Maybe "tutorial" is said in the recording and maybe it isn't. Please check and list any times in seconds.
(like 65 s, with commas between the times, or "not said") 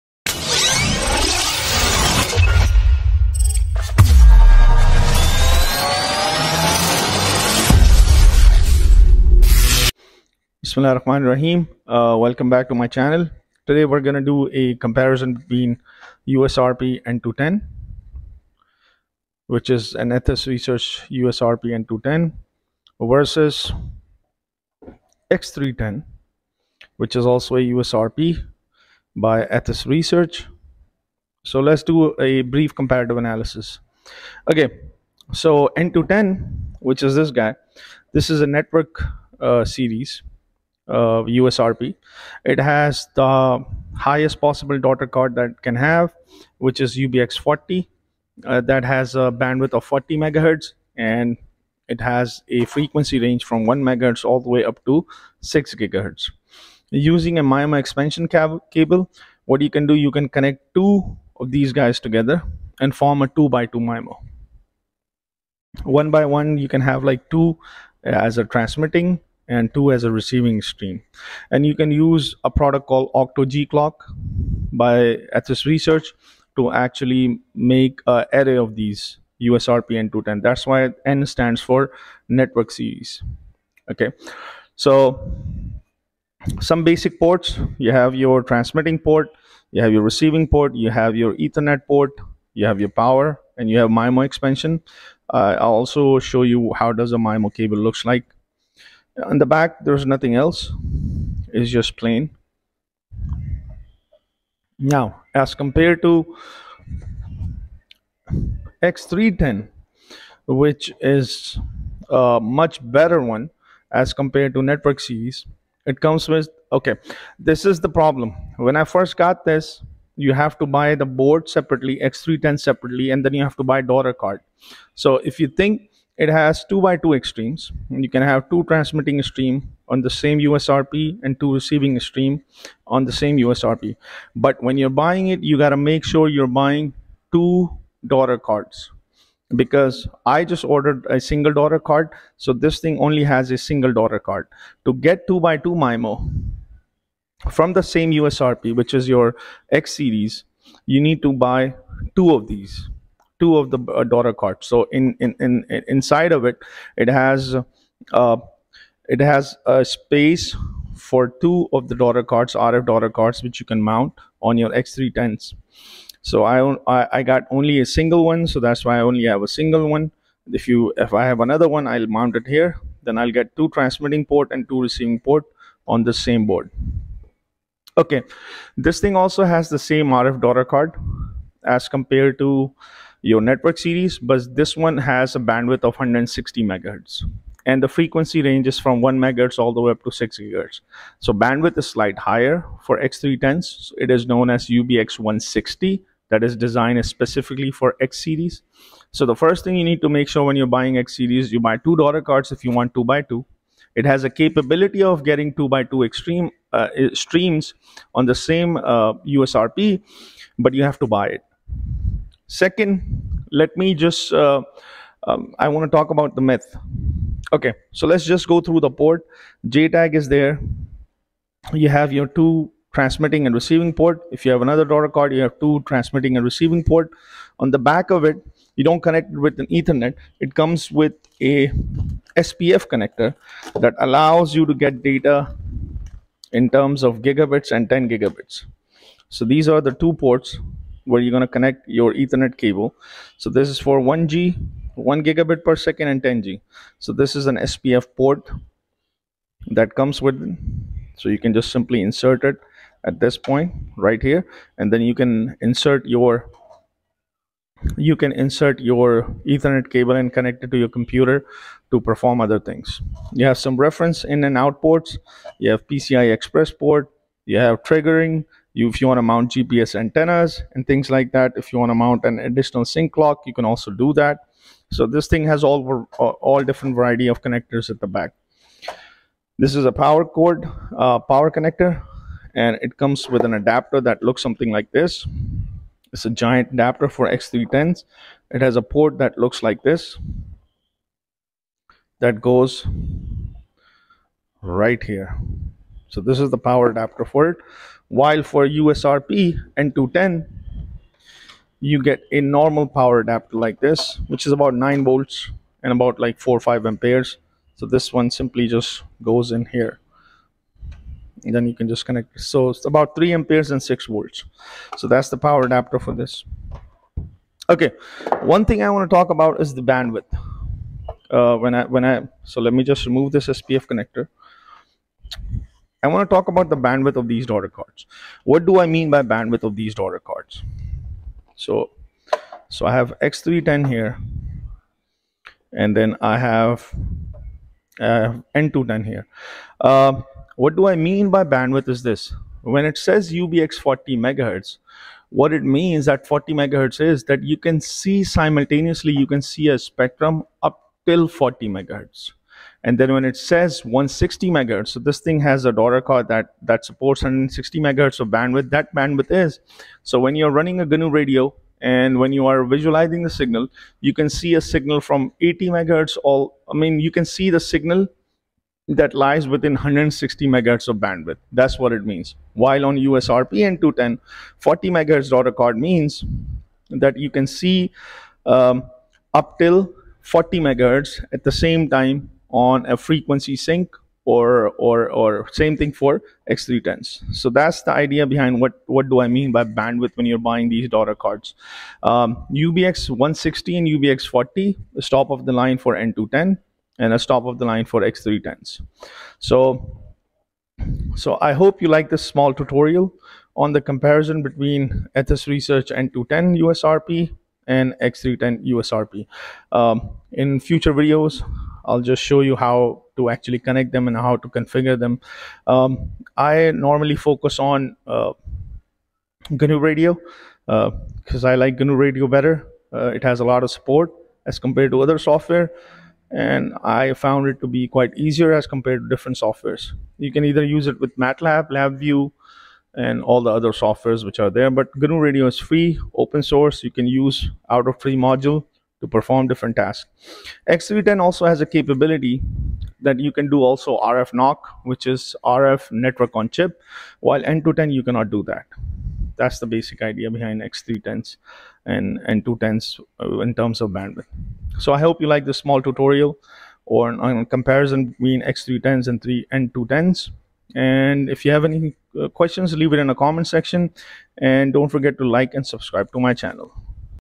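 402 s, 455 s.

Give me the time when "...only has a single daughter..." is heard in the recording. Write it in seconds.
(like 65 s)
142 s.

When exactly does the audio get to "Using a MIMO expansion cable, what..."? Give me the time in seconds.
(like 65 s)
56 s.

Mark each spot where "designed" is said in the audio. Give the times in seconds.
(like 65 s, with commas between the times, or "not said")
196 s.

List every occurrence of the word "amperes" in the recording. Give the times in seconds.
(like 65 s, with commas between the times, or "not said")
306 s, 313 s.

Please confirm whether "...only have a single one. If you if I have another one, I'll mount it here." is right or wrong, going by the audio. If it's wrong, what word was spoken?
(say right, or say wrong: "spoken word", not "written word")
right.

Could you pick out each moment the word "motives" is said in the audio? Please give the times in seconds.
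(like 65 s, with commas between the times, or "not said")
not said.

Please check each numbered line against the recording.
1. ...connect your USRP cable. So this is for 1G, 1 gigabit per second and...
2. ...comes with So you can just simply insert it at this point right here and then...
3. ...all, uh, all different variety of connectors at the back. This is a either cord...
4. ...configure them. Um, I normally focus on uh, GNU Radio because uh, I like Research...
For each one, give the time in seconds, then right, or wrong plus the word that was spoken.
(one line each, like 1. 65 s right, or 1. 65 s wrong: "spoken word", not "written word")
1. 241 s wrong: "Ethernet", not "USRP"
2. 249 s right
3. 275 s wrong: "power", not "either"
4. 414 s wrong: "GNU", not "Research".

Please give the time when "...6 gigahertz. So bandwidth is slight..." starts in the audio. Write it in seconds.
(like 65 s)
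190 s.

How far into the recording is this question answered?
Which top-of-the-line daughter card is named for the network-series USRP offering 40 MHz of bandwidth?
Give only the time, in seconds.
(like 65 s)
46 s.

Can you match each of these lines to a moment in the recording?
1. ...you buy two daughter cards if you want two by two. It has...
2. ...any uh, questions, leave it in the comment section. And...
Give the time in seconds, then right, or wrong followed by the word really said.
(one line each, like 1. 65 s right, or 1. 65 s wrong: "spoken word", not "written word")
1. 201 s right
2. 461 s right.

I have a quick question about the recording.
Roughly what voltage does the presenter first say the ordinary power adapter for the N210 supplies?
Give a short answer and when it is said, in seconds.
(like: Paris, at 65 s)
9 volts, at 304 s.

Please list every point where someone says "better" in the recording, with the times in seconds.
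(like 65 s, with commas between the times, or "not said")
112 s, 422 s.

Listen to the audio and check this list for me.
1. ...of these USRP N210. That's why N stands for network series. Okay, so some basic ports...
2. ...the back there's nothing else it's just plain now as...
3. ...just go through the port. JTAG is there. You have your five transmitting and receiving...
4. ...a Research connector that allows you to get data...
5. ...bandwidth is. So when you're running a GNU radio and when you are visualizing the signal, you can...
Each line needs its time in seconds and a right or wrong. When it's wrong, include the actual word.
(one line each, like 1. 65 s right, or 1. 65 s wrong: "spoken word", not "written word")
1. 78 s right
2. 99 s right
3. 218 s wrong: "two", not "five"
4. 231 s wrong: "SPF", not "Research"
5. 358 s right.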